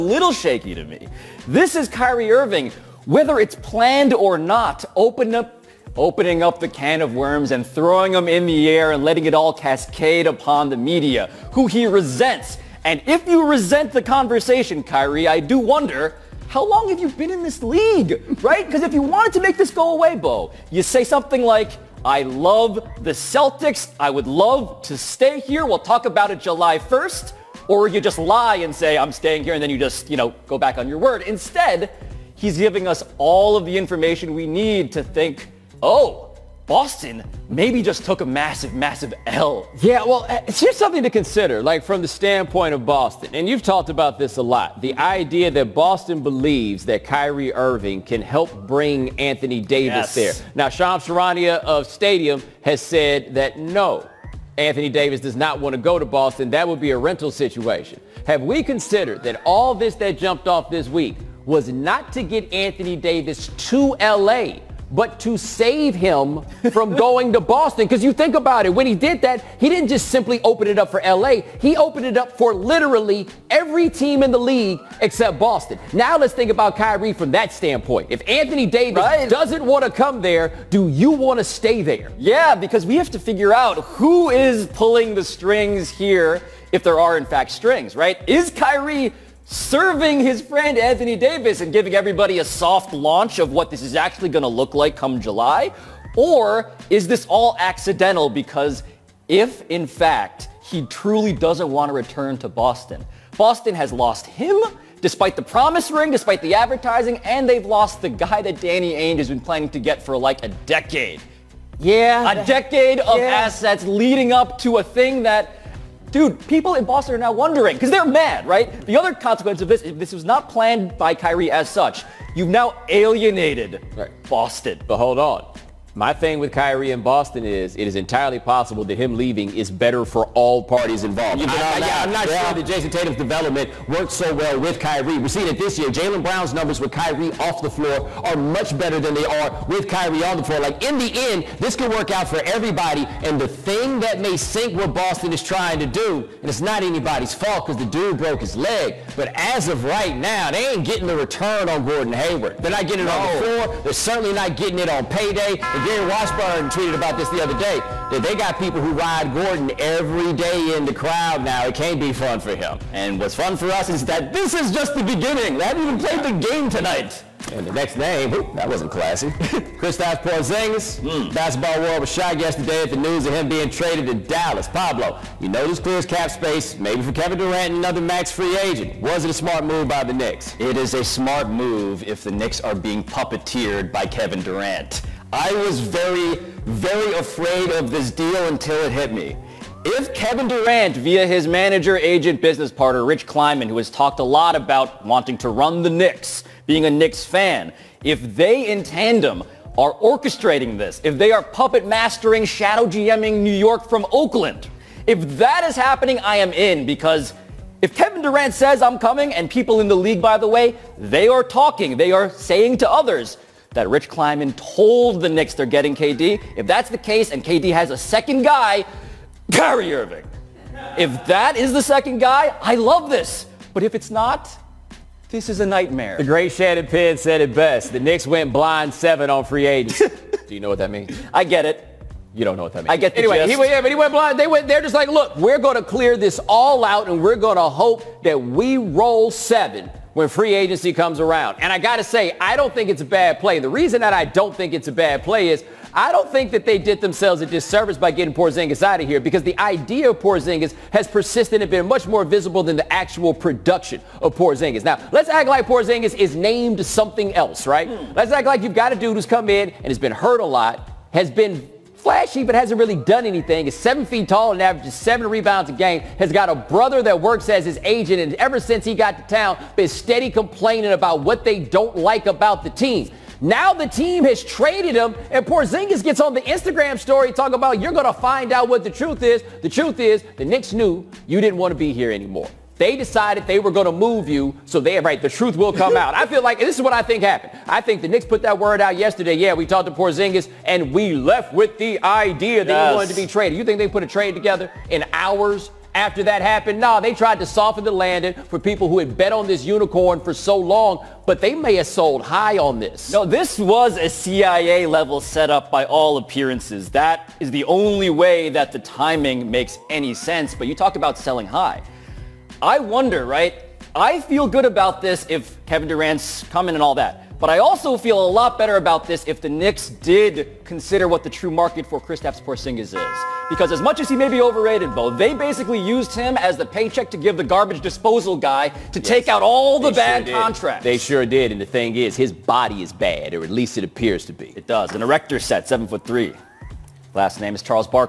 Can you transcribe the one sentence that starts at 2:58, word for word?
Was it a smart move by the Knicks?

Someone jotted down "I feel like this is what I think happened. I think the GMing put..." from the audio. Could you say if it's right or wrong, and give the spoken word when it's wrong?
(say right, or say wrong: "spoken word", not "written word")
wrong: "Knicks", not "GMing".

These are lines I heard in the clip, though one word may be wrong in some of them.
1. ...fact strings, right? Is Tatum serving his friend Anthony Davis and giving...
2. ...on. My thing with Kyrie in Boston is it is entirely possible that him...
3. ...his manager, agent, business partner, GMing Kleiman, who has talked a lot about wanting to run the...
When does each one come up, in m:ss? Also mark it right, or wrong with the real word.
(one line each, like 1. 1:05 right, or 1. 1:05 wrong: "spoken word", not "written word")
1. 1:27 wrong: "Kyrie", not "Tatum"
2. 2:05 right
3. 3:11 wrong: "Rich", not "GMing".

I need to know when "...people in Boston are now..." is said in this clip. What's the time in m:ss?
1:56.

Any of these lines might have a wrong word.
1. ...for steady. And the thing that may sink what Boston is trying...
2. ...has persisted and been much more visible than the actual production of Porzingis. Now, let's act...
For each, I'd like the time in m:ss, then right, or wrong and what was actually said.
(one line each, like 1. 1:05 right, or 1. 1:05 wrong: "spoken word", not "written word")
1. 2:22 wrong: "everybody", not "steady"
2. 4:10 right.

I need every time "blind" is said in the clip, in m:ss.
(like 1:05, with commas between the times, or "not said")
3:48, 3:54.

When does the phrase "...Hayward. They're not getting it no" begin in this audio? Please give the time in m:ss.
2:32.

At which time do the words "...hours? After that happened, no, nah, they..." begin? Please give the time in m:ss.
4:55.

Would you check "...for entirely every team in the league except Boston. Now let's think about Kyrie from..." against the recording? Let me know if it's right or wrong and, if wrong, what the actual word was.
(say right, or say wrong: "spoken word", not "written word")
wrong: "literally", not "entirely".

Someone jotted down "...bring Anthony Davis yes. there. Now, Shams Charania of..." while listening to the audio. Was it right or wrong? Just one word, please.
right.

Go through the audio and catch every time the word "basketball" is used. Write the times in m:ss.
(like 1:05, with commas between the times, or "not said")
2:51.